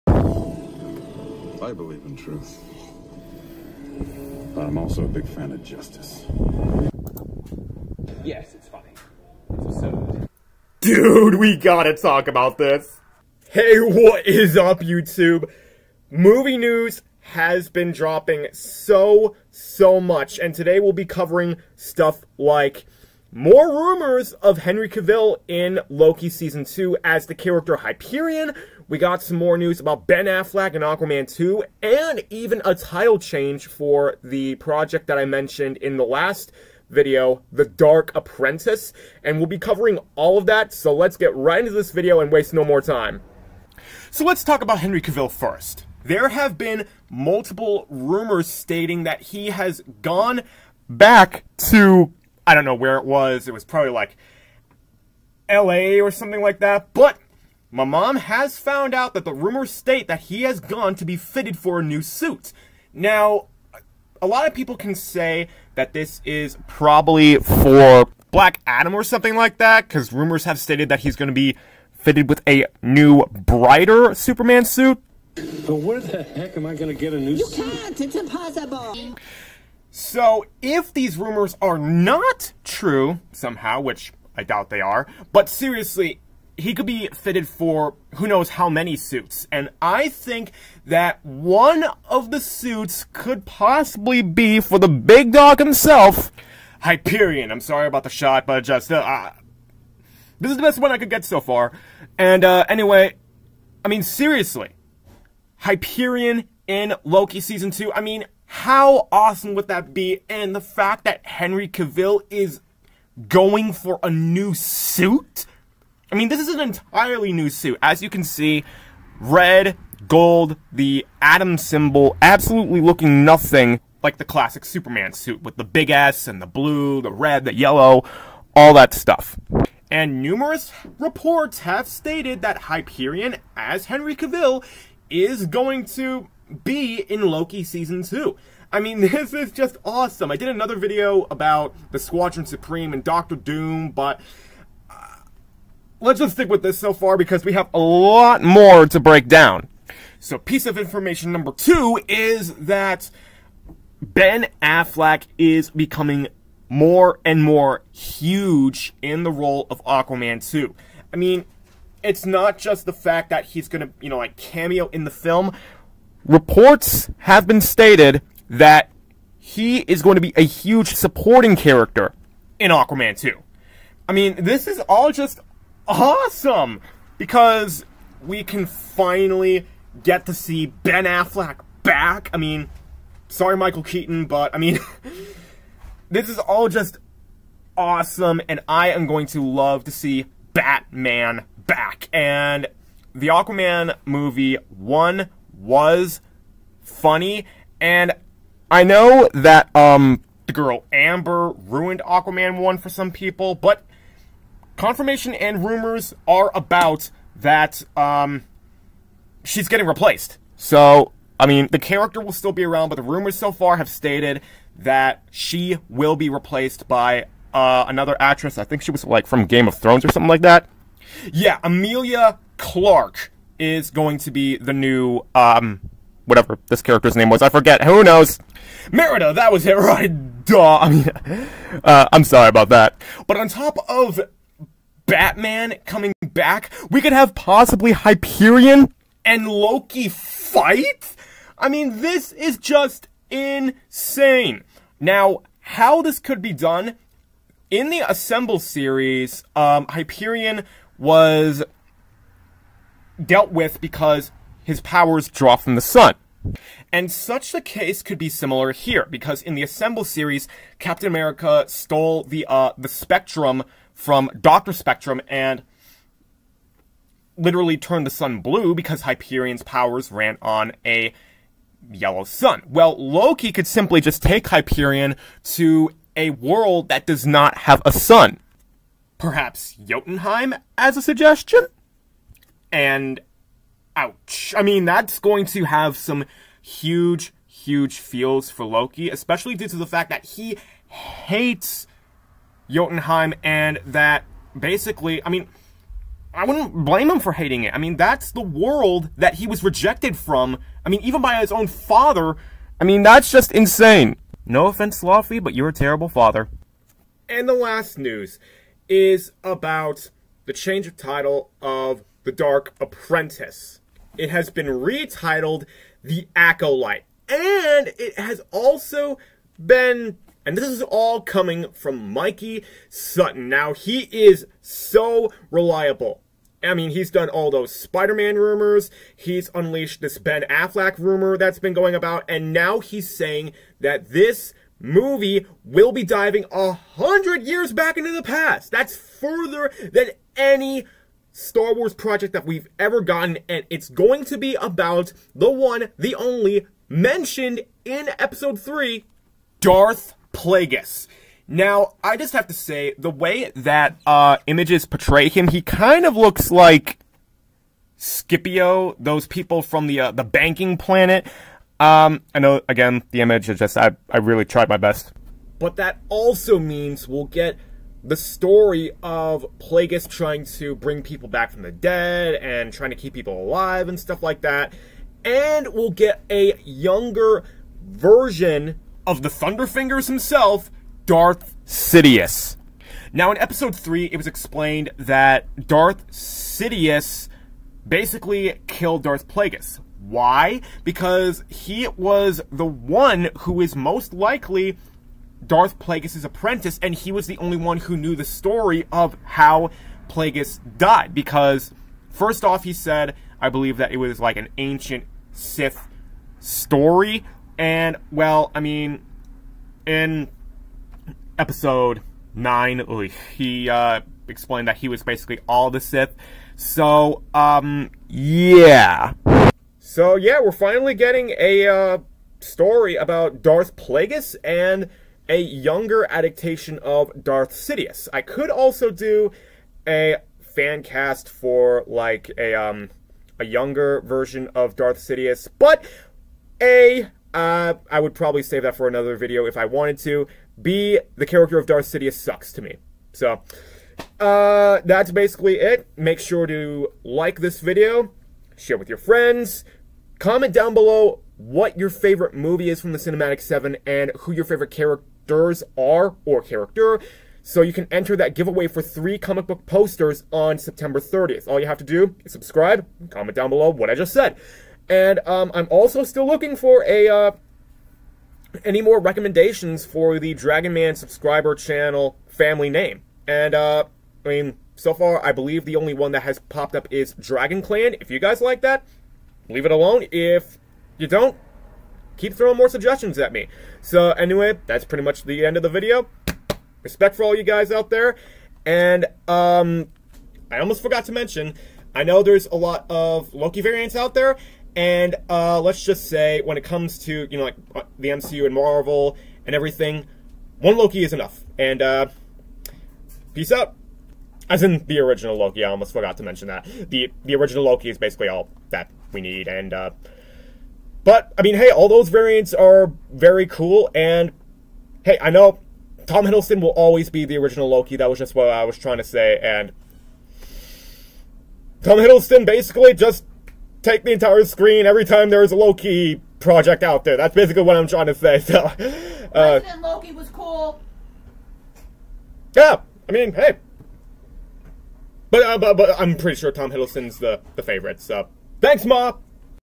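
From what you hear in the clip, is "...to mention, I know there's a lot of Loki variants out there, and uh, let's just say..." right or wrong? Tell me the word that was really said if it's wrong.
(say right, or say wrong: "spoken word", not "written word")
right.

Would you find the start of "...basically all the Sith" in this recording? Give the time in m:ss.
6:55.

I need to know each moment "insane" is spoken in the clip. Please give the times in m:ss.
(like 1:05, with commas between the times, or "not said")
4:03, 5:03.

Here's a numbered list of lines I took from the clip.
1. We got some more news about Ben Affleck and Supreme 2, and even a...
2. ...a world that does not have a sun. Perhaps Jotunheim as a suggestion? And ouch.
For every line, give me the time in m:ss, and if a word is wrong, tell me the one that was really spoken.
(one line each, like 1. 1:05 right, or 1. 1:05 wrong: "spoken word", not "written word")
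1. 0:28 wrong: "Aquaman", not "Supreme"
2. 4:36 right.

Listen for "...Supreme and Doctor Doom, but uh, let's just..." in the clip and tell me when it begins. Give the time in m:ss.
2:22.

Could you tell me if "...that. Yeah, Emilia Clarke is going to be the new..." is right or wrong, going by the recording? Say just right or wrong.
right.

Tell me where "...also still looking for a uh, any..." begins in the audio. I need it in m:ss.
7:45.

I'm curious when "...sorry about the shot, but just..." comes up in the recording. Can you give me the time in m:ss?
1:37.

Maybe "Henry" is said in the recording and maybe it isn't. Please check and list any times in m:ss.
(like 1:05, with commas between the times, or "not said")
0:24, 0:44, 1:51, 2:13.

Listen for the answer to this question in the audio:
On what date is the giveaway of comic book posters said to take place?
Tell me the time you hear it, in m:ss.
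7:40.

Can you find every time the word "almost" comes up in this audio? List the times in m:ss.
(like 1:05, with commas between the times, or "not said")
8:10, 8:25.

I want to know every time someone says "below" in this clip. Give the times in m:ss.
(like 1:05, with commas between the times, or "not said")
7:30, 7:43.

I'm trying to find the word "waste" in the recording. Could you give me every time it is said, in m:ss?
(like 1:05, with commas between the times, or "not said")
0:42.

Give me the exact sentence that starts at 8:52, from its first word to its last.
Yeah, I mean, hey, but uh, but, but I'm pretty sure Tom Hiddleston's the the favorite.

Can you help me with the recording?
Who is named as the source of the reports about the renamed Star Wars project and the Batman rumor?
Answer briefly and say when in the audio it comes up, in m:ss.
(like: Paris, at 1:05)
Mikey Sutton, at 5:22.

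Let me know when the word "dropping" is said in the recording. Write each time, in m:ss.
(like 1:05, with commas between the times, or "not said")
0:17.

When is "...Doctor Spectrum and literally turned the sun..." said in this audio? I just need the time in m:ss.
4:24.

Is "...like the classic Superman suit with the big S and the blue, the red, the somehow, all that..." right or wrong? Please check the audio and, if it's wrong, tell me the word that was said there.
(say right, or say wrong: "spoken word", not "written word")
wrong: "yellow", not "somehow".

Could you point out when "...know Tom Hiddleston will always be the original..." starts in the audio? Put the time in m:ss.
8:35.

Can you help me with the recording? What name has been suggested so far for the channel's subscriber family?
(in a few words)
Dragon Clan.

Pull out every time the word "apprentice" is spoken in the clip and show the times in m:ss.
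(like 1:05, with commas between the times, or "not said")
0:38, 5:12, 6:36.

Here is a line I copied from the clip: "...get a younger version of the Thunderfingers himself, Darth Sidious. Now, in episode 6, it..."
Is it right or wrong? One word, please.
wrong.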